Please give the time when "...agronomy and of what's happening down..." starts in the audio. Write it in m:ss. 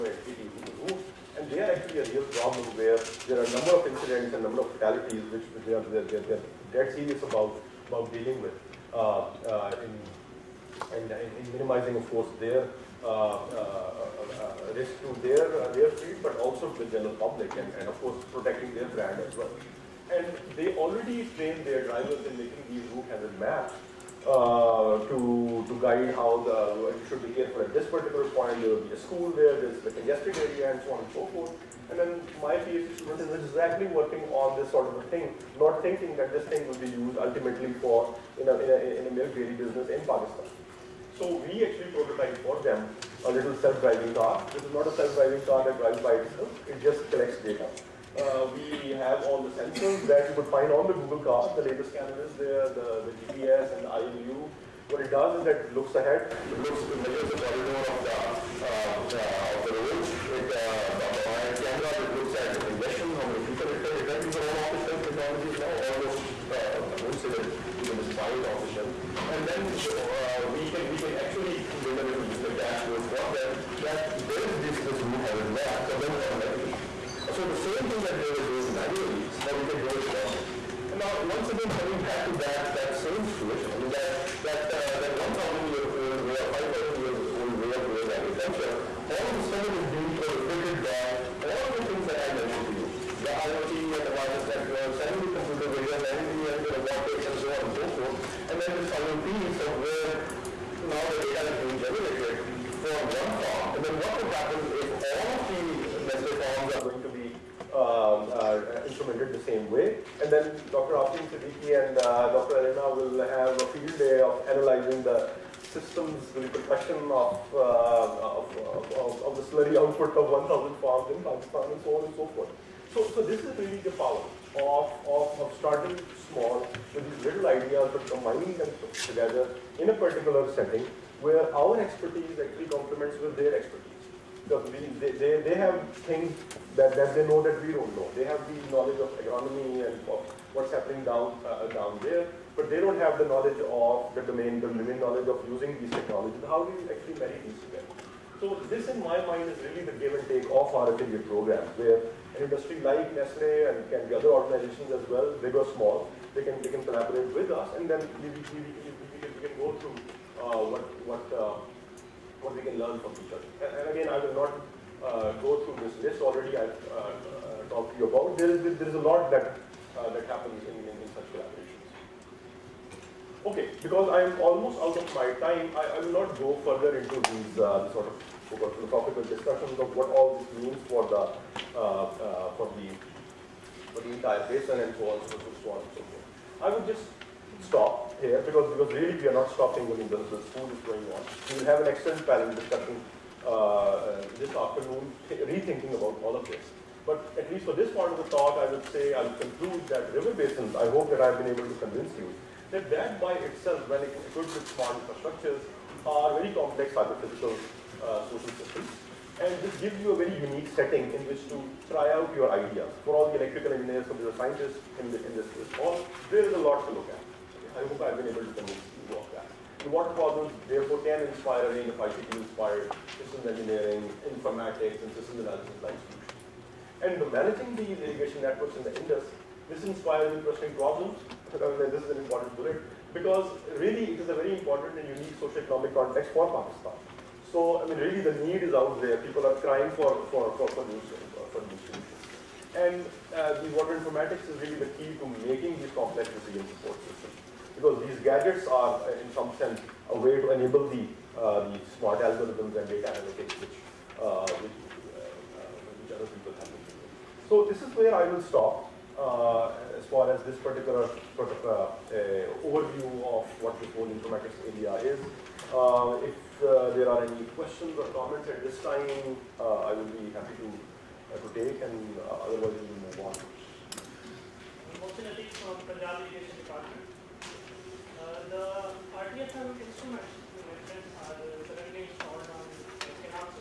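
2:19.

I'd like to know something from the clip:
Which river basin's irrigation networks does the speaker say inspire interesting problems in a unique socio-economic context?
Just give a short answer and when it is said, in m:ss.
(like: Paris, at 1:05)
Indus, at 3:48.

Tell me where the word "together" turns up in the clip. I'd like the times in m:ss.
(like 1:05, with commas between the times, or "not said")
2:08, 2:27.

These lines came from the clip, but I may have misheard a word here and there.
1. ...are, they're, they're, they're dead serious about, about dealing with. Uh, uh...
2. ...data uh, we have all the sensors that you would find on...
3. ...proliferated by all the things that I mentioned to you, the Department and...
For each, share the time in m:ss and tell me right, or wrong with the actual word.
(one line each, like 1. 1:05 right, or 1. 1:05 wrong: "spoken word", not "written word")
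1. 0:05 right
2. 0:47 right
3. 1:30 wrong: "IoT", not "Department".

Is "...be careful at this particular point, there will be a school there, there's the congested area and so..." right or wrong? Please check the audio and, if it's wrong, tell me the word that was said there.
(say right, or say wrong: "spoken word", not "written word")
right.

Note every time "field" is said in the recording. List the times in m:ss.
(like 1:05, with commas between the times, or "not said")
0:15, 1:53.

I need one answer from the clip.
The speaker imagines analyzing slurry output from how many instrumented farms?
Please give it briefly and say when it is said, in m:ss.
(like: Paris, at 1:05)
1,000, at 2:00.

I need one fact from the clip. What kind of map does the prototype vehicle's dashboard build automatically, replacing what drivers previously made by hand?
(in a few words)
Route hazard map.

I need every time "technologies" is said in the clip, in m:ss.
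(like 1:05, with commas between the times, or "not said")
1:05, 2:25.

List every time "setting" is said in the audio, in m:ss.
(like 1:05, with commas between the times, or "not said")
2:10, 3:30.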